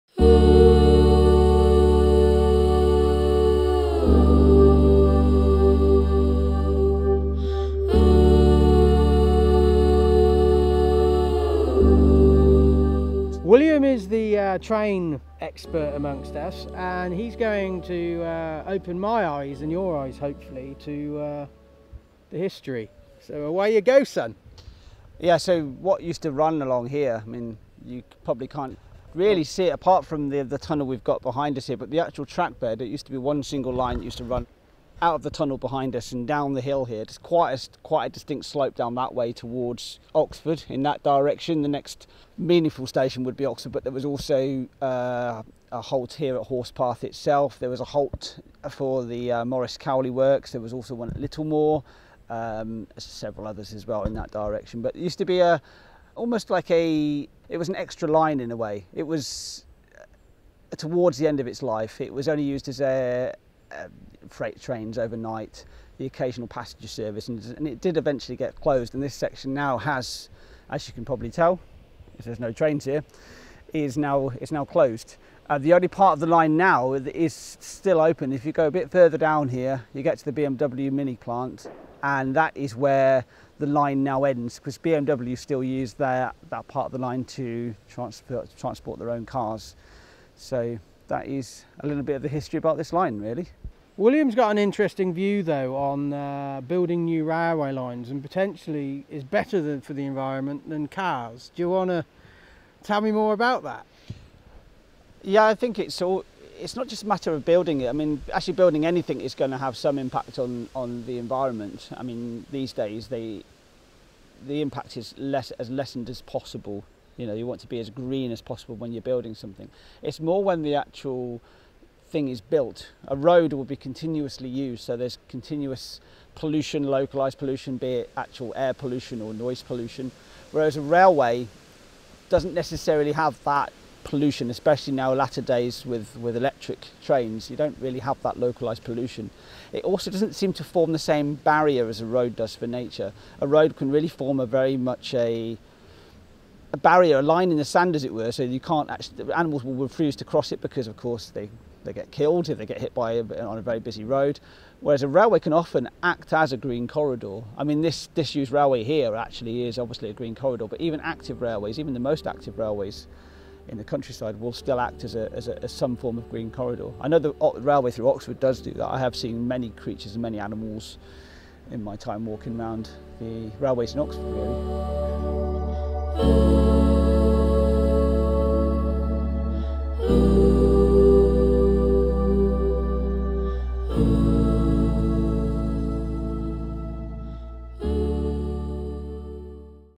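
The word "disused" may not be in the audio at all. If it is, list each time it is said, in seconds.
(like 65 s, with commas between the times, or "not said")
158 s.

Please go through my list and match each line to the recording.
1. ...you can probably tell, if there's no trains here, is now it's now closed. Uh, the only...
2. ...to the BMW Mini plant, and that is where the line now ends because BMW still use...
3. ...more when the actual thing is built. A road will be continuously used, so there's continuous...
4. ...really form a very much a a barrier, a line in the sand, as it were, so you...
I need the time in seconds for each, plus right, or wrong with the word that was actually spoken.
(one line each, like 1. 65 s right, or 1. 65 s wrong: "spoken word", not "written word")
1. 70 s right
2. 80 s right
3. 120 s right
4. 143 s right.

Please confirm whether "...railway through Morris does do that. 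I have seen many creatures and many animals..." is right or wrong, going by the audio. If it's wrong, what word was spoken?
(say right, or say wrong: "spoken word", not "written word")
wrong: "Oxford", not "Morris".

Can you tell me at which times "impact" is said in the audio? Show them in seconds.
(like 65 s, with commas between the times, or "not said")
109 s, 114 s.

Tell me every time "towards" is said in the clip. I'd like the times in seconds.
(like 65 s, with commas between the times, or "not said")
39 s, 60 s.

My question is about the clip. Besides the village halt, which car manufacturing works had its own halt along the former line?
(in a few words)
Morris Cowley Works.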